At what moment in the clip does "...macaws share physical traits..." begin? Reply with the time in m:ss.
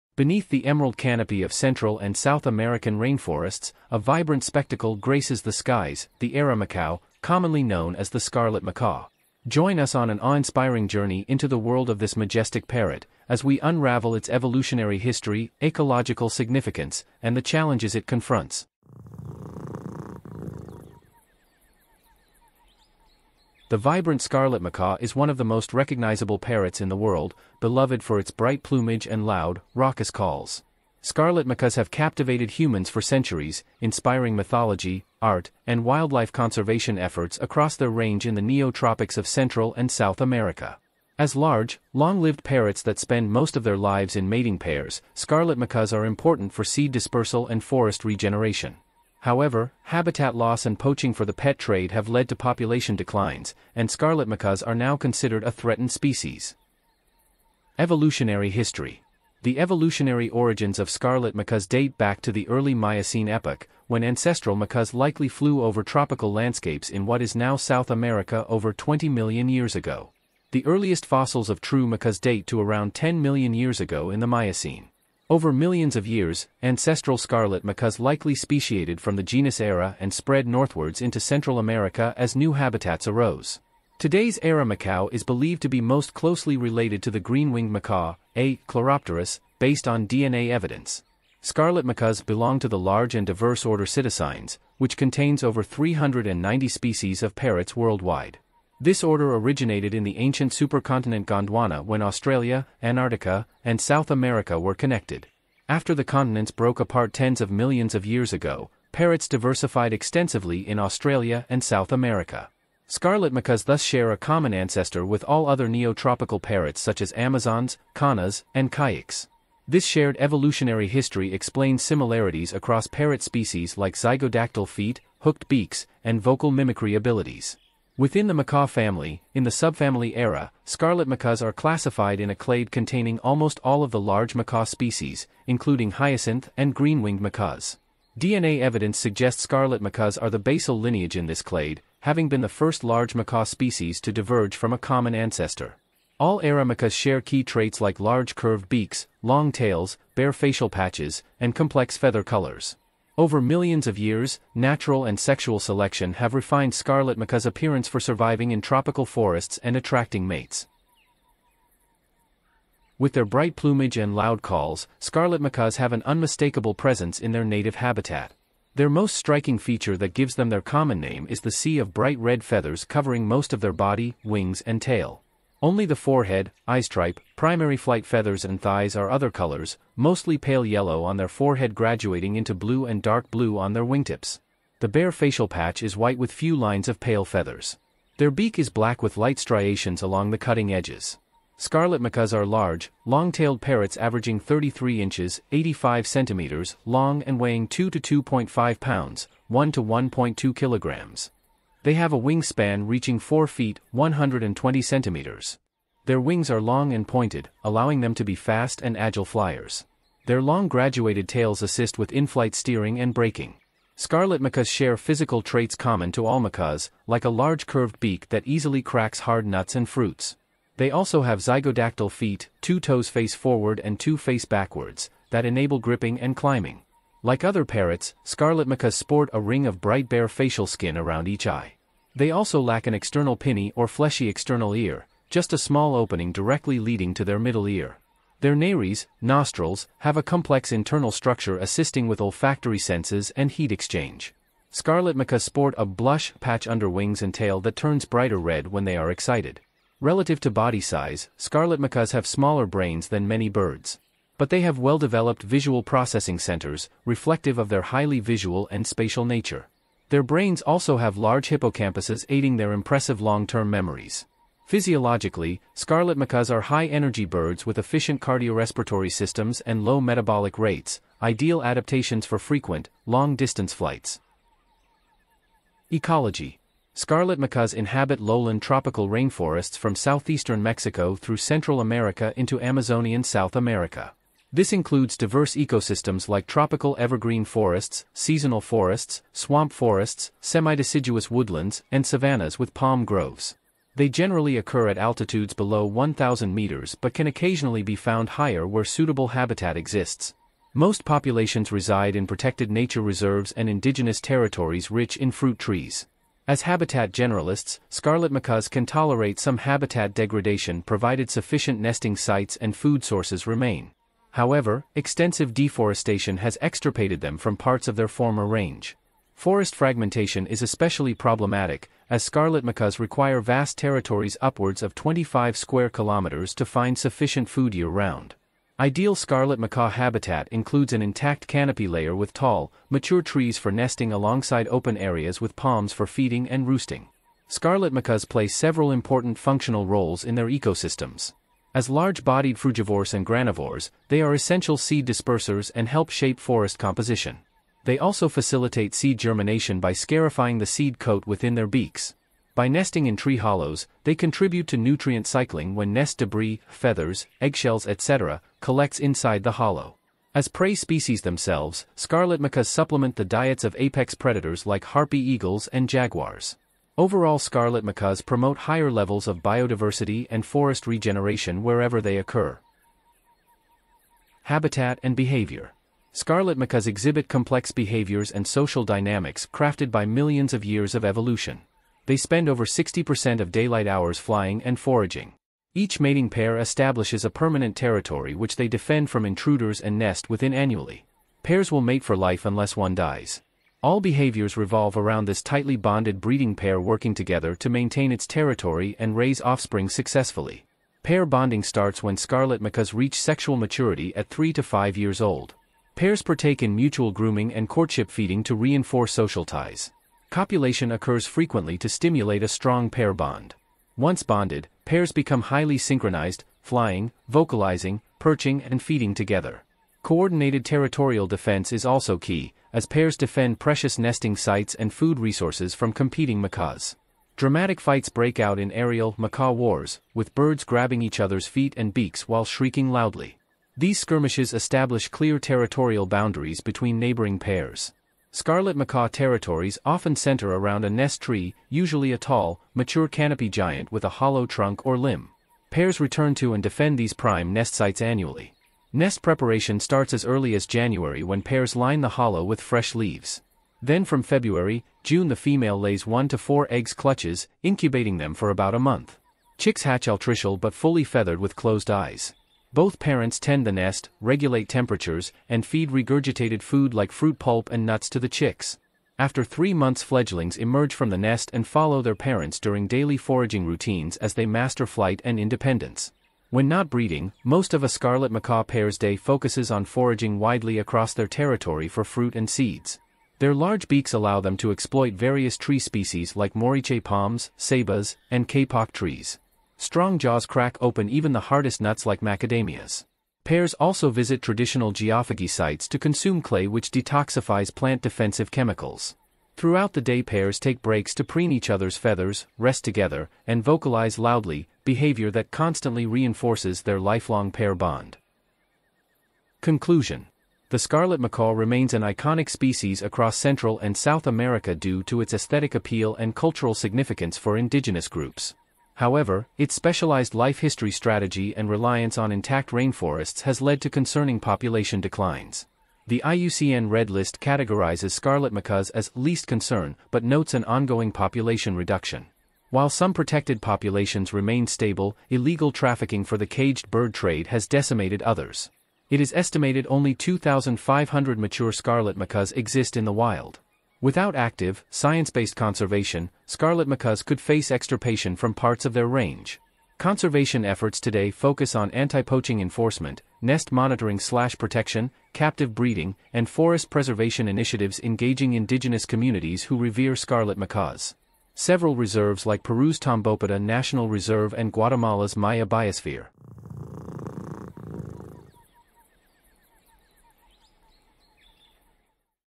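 3:34.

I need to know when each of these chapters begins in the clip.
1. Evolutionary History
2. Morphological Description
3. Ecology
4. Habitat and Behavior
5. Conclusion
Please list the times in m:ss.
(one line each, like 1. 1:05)
1. 0:57
2. 2:41
3. 4:35
4. 6:13
5. 8:29.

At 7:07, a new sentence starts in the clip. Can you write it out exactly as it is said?
Dramatic fights break out in aerial macaw wars, with birds grabbing each other's feet and beaks while shrieking loudly.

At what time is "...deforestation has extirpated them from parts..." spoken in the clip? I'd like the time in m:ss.
5:15.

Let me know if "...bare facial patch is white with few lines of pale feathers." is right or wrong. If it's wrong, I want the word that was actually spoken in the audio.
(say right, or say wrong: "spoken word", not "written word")
right.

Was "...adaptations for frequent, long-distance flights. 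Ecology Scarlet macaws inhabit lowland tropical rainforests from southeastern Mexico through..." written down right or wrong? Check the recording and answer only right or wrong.
right.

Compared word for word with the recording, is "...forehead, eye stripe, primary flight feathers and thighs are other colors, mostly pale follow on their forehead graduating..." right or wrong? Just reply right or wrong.
wrong.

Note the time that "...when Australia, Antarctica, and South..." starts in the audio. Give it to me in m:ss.
1:41.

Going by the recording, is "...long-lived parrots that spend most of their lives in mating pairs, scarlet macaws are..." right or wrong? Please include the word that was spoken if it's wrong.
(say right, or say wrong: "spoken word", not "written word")
right.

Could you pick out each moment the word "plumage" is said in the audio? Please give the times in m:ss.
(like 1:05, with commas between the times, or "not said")
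0:28, 2:43.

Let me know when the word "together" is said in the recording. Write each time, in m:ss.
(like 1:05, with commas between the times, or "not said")
6:37, 6:59, 8:22.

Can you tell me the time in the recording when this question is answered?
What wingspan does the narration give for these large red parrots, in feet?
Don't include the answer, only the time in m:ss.
3:23.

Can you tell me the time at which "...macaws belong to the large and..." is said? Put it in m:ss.
1:31.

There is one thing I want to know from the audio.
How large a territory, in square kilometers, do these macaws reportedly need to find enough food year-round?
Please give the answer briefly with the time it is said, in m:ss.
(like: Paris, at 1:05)
25 square kilometers, at 5:24.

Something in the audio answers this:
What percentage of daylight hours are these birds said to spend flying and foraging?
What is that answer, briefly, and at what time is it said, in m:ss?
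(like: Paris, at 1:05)
60%, at 6:22.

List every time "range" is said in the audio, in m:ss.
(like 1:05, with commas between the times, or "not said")
0:37, 5:18, 9:09.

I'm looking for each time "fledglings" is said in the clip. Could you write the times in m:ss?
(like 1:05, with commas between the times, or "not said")
7:50.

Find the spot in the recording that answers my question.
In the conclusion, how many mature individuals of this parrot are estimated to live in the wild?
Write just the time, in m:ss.
9:00.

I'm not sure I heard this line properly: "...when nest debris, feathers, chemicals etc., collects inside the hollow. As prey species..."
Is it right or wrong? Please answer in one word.
wrong.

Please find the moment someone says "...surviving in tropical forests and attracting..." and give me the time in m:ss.
2:37.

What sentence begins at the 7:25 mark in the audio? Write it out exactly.
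Pairs return to and defend these prime nest sites annually.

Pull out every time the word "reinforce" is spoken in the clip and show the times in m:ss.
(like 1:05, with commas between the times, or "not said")
6:48, 8:26.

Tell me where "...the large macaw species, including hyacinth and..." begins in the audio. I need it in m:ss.
2:13.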